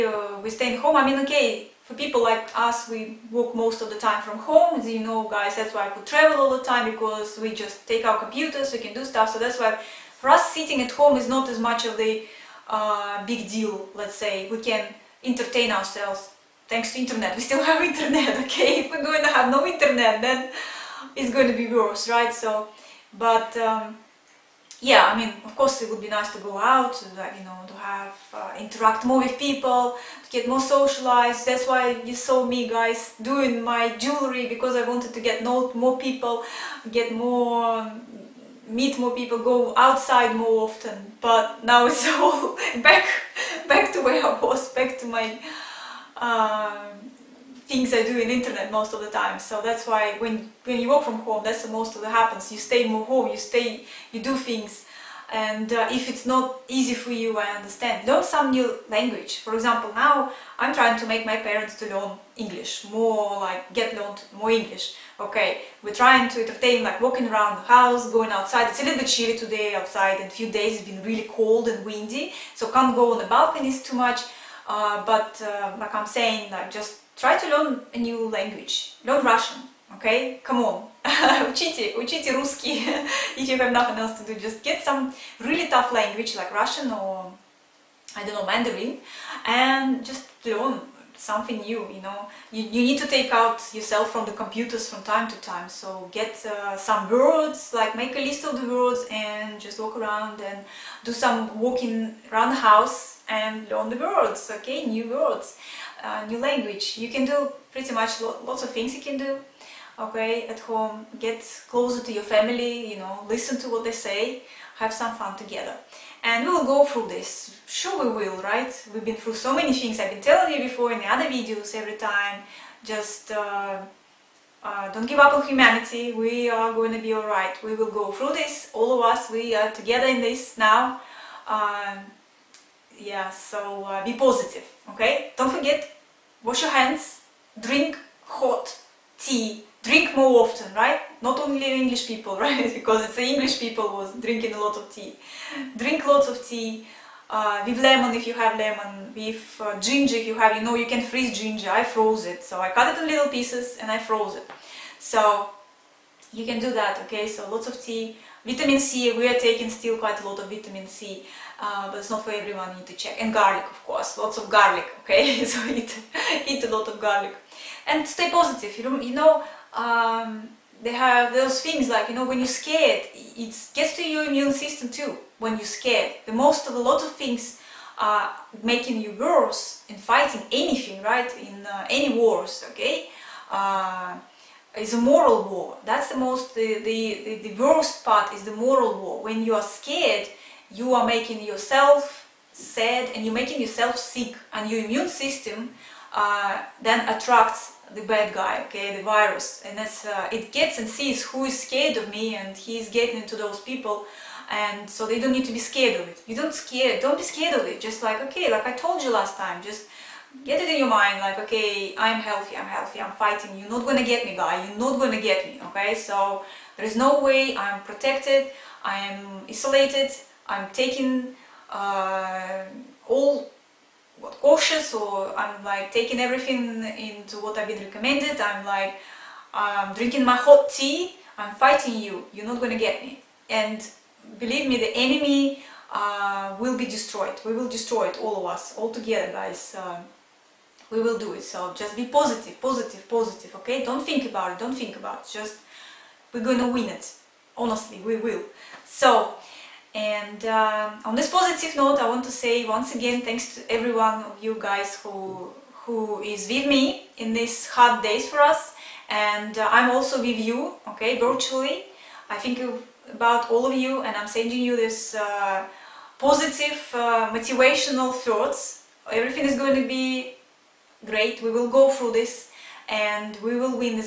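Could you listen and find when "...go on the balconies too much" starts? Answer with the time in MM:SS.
01:12.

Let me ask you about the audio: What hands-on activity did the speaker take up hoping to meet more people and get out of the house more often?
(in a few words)
jewelry.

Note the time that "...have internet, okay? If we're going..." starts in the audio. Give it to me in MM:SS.
00:17.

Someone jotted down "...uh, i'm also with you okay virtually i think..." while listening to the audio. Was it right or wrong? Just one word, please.
right.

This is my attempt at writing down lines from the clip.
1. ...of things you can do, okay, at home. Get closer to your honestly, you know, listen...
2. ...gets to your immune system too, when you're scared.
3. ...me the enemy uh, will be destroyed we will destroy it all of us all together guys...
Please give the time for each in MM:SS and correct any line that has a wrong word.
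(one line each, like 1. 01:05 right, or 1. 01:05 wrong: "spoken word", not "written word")
1. 01:48 wrong: "family", not "honestly"
2. 02:53 right
3. 03:54 right.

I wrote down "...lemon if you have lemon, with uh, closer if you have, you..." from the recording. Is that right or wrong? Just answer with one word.
wrong.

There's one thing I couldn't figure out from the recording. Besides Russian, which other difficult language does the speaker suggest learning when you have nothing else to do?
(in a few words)
Mandarin.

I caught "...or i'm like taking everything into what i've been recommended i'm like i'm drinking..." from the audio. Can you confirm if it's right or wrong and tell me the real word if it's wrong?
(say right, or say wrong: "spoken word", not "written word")
right.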